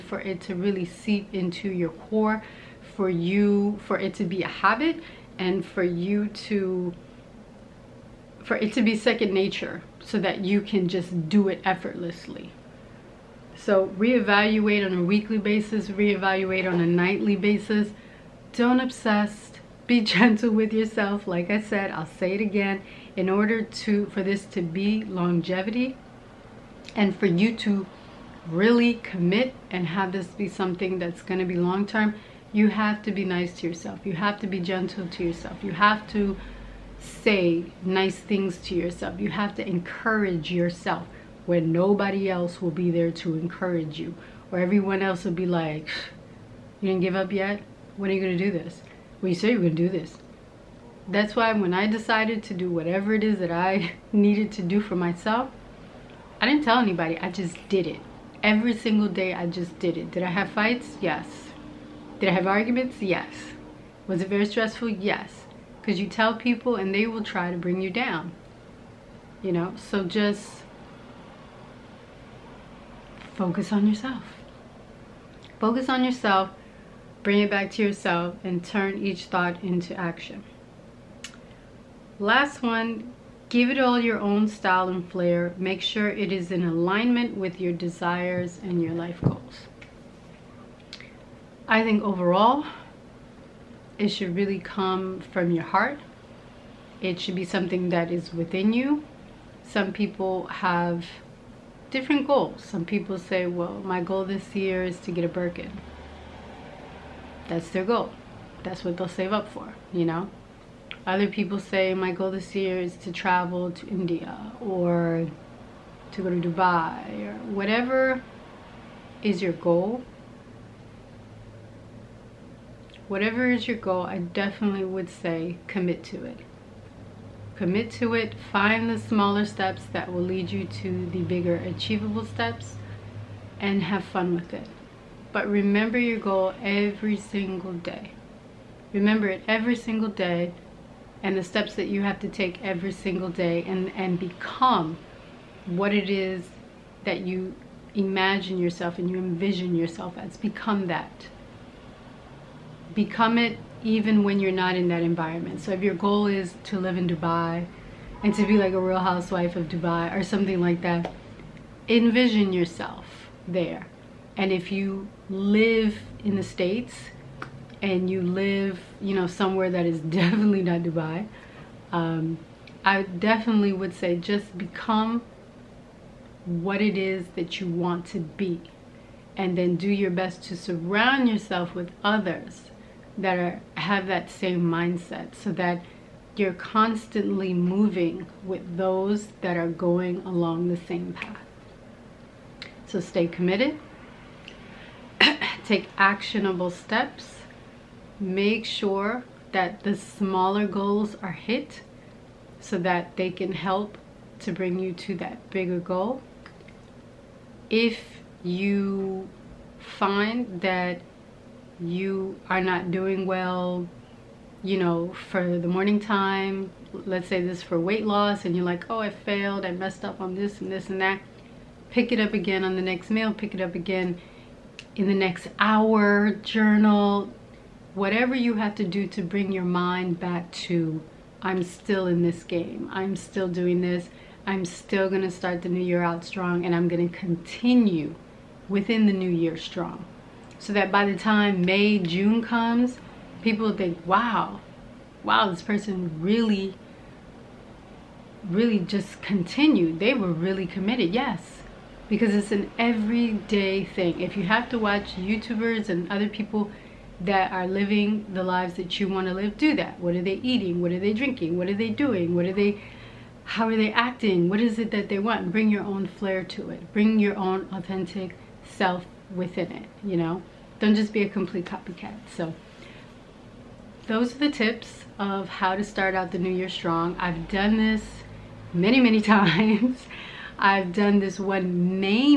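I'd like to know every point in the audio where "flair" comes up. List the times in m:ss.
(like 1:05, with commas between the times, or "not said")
1:25, 4:26.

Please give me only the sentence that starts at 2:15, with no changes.
But remember your goal every single day.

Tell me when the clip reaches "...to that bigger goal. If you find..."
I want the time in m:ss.
3:24.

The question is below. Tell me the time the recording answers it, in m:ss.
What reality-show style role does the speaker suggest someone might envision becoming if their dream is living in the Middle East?
2:38.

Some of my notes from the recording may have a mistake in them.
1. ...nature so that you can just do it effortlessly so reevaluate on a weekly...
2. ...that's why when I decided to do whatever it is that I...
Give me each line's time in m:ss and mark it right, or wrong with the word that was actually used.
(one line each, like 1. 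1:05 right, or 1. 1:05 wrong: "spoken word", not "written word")
1. 0:09 right
2. 0:51 right.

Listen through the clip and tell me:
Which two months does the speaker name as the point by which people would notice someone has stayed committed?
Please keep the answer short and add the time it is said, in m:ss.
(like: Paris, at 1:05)
May, June, at 4:01.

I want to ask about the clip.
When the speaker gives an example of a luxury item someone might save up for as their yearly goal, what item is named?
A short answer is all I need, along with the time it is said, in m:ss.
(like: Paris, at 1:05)
Birkin, at 1:45.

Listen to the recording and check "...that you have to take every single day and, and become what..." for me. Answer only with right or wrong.
right.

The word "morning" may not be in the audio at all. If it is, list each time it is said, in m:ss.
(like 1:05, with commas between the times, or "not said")
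3:35.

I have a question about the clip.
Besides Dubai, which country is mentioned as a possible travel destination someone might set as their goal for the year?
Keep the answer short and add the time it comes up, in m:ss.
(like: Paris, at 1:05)
India, at 1:53.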